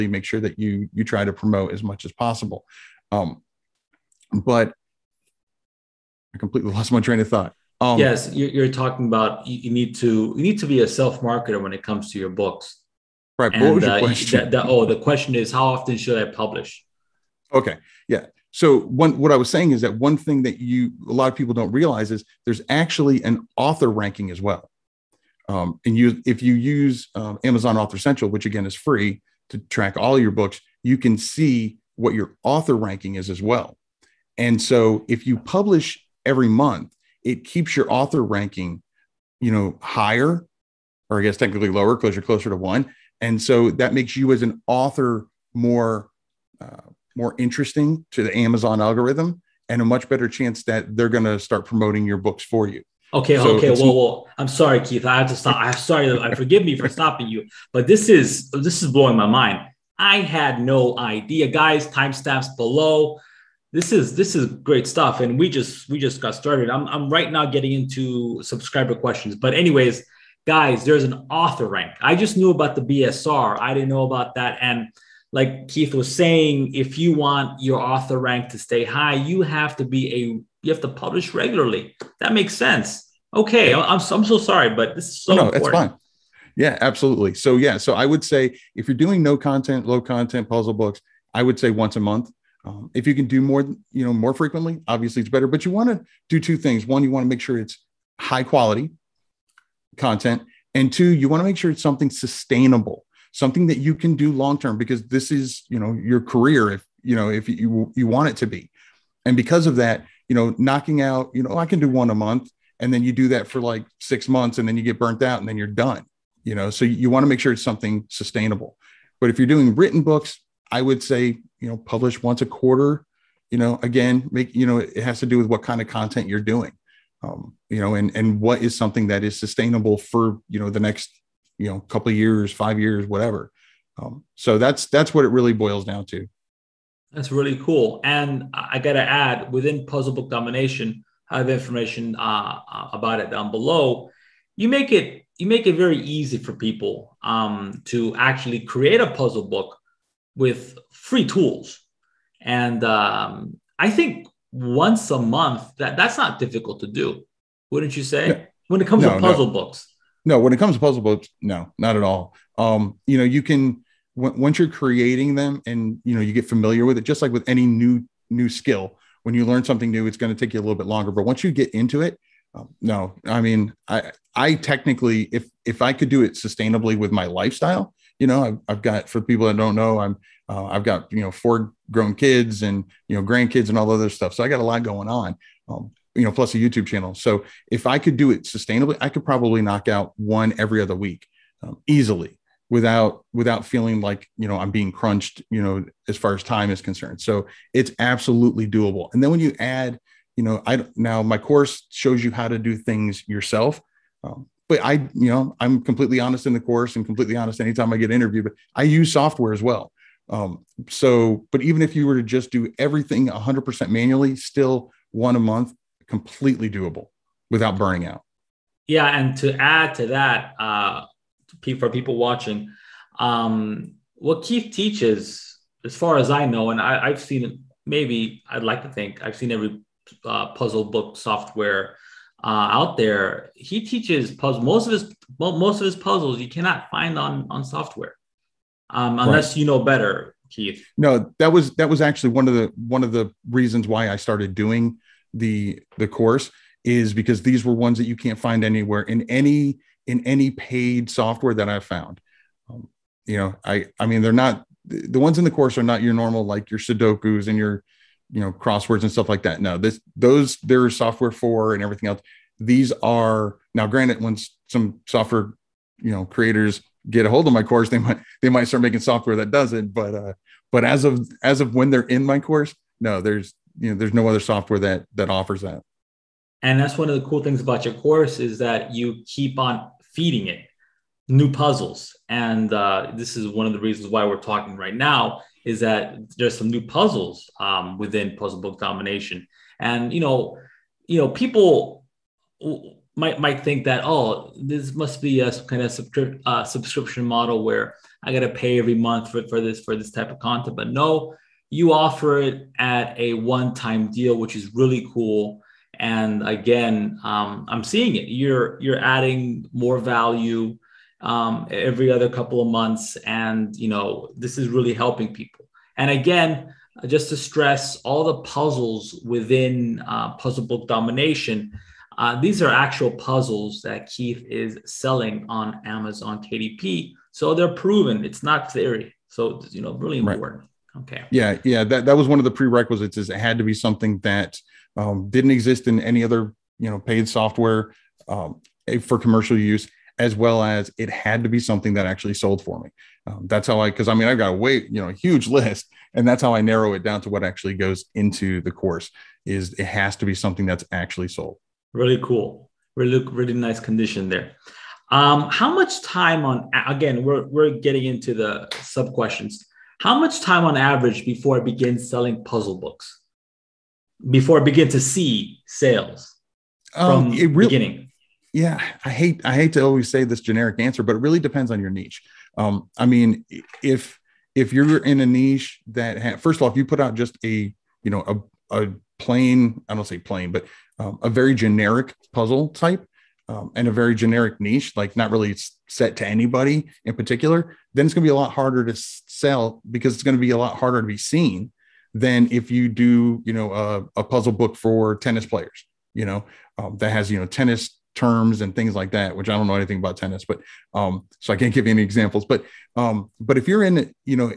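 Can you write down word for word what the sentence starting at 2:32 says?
And um, I think once a month that that's not difficult to do, wouldn't you say?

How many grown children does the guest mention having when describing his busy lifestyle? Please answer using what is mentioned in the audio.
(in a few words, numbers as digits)
four.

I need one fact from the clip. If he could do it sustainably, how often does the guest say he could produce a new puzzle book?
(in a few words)
every other week.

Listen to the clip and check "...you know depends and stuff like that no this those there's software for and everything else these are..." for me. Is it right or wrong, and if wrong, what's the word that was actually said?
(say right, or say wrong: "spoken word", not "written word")
wrong: "crosswords", not "depends".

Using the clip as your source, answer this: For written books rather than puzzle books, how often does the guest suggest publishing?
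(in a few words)
once a quarter.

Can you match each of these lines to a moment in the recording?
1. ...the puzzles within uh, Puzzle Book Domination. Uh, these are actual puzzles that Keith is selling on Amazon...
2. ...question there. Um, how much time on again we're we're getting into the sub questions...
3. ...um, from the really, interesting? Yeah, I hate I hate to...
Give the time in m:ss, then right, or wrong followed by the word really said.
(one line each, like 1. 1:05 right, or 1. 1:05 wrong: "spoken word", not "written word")
1. 5:18 right
2. 5:53 wrong: "condition", not "question"
3. 6:06 wrong: "beginning", not "interesting".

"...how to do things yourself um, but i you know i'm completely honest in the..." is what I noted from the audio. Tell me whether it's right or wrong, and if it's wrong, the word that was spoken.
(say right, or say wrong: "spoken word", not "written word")
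right.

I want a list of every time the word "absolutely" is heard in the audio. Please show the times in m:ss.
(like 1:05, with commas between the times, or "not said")
1:26, 3:17.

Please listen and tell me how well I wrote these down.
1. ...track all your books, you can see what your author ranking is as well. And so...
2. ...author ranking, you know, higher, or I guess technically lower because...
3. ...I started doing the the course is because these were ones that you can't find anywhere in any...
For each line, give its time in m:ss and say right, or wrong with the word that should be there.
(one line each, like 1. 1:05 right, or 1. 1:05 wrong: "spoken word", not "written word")
1. 0:29 right
2. 0:37 right
3. 4:04 right.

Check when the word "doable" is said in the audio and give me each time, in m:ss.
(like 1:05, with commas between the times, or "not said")
3:18, 3:36.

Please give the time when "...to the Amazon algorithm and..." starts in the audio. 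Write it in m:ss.
0:48.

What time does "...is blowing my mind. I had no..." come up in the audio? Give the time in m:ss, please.
0:58.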